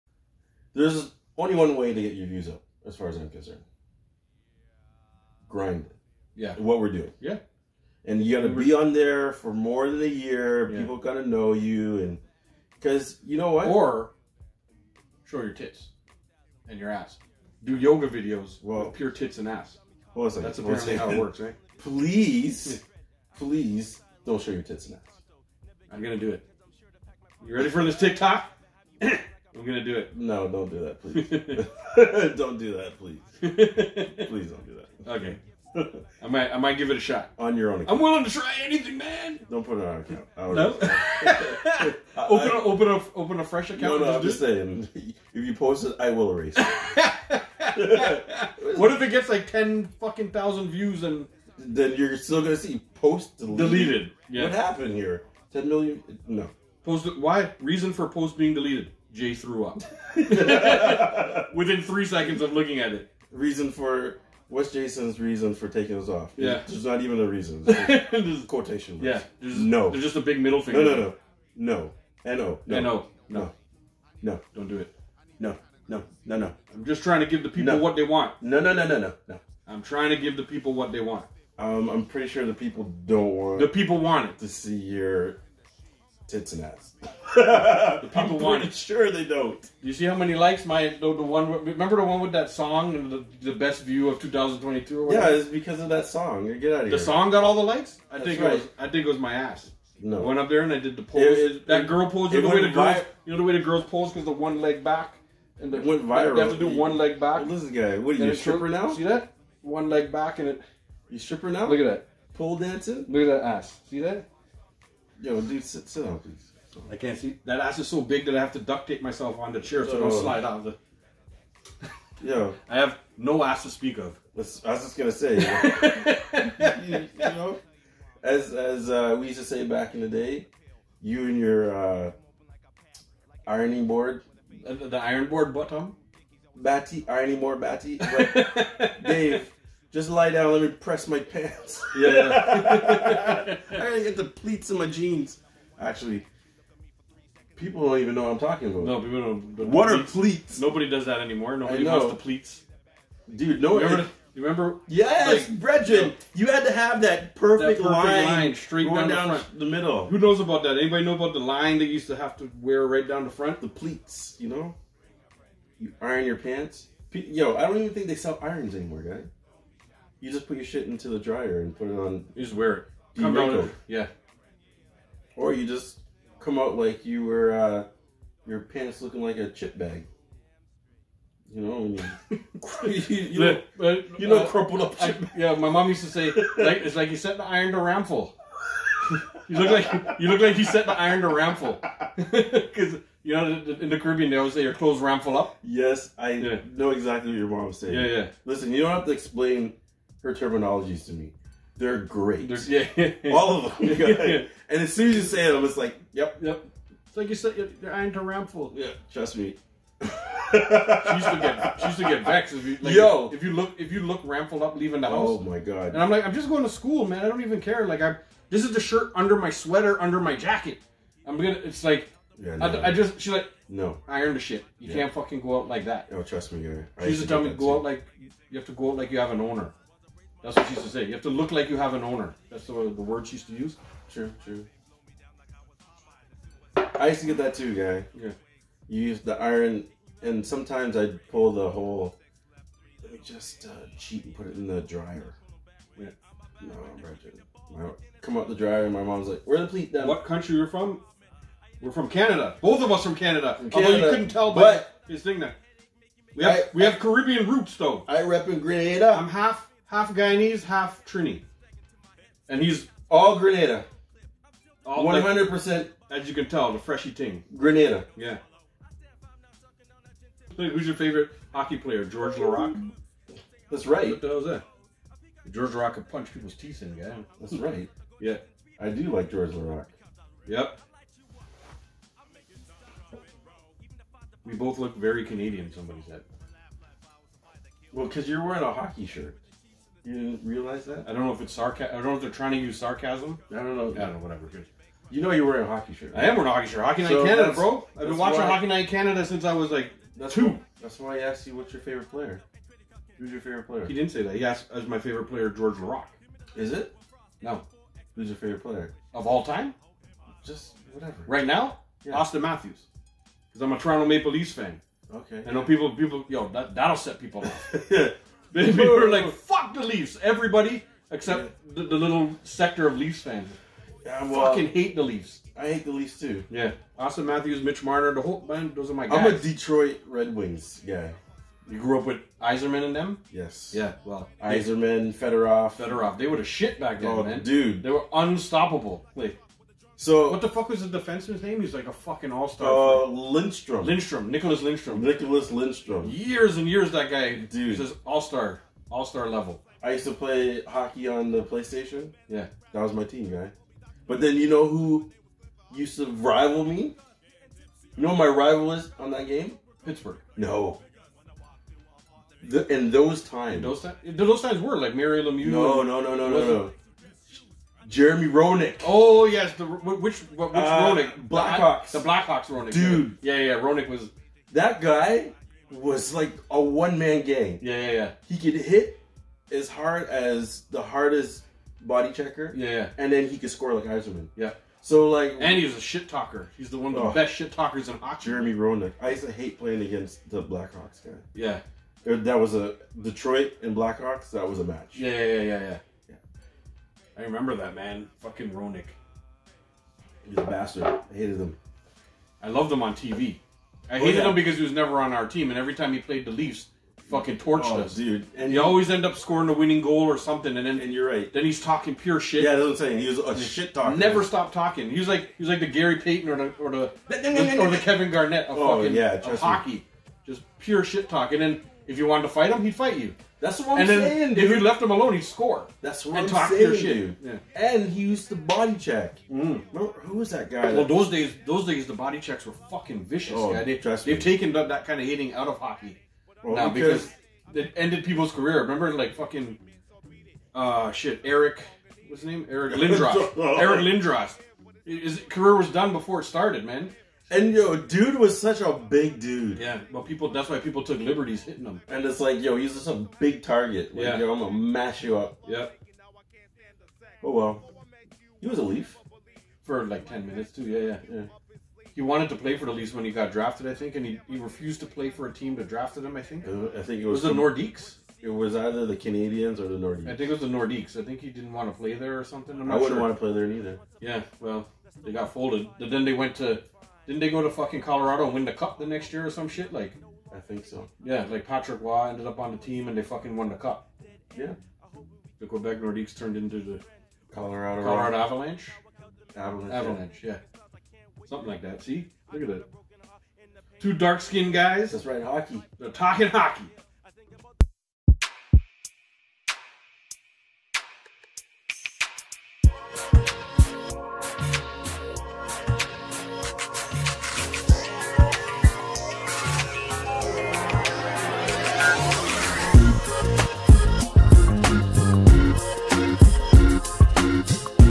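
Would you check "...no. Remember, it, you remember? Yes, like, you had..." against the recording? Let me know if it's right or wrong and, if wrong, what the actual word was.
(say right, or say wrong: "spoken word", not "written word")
right.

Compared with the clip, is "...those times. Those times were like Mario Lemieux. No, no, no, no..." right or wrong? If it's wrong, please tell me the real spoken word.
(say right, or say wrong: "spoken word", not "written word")
right.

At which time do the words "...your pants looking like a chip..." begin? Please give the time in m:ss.
2:58.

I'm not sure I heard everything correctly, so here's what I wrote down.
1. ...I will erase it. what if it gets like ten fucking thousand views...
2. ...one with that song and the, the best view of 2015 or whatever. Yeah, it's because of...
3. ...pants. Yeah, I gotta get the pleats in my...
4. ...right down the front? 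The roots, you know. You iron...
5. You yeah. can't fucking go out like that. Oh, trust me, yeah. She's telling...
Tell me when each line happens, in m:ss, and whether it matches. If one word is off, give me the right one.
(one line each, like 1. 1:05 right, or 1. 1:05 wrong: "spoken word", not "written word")
1. 0:45 right
2. 1:32 wrong: "2022", not "2015"
3. 2:21 right
4. 2:42 wrong: "pleats", not "roots"
5. 3:44 right.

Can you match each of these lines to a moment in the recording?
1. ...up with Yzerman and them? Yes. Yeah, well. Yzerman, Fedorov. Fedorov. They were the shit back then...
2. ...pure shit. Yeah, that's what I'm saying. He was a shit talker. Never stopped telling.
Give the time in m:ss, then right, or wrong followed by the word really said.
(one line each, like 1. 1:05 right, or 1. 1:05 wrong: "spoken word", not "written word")
1. 5:31 right
2. 6:51 wrong: "talking", not "telling".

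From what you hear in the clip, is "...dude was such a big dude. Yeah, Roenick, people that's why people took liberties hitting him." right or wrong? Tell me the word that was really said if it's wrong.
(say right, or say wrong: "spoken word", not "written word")
wrong: "Well", not "Roenick".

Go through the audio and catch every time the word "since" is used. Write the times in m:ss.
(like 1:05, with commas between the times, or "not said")
4:59.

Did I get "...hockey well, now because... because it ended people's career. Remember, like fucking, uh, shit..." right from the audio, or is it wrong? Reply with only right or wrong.
right.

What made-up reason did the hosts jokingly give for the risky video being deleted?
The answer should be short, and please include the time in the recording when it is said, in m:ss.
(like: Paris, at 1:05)
Jay threw up, at 0:59.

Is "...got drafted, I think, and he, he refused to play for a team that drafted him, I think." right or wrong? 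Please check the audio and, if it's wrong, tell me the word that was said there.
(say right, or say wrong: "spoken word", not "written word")
right.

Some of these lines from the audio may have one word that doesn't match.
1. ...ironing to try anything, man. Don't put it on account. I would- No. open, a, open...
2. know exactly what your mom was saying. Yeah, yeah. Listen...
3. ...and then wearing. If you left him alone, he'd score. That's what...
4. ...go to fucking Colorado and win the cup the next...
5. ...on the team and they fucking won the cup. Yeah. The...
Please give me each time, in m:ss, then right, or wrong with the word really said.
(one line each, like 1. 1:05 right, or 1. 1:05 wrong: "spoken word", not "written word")
1. 0:37 wrong: "willing", not "ironing"
2. 3:16 right
3. 7:03 wrong: "saying", not "wearing"
4. 7:57 right
5. 8:02 right.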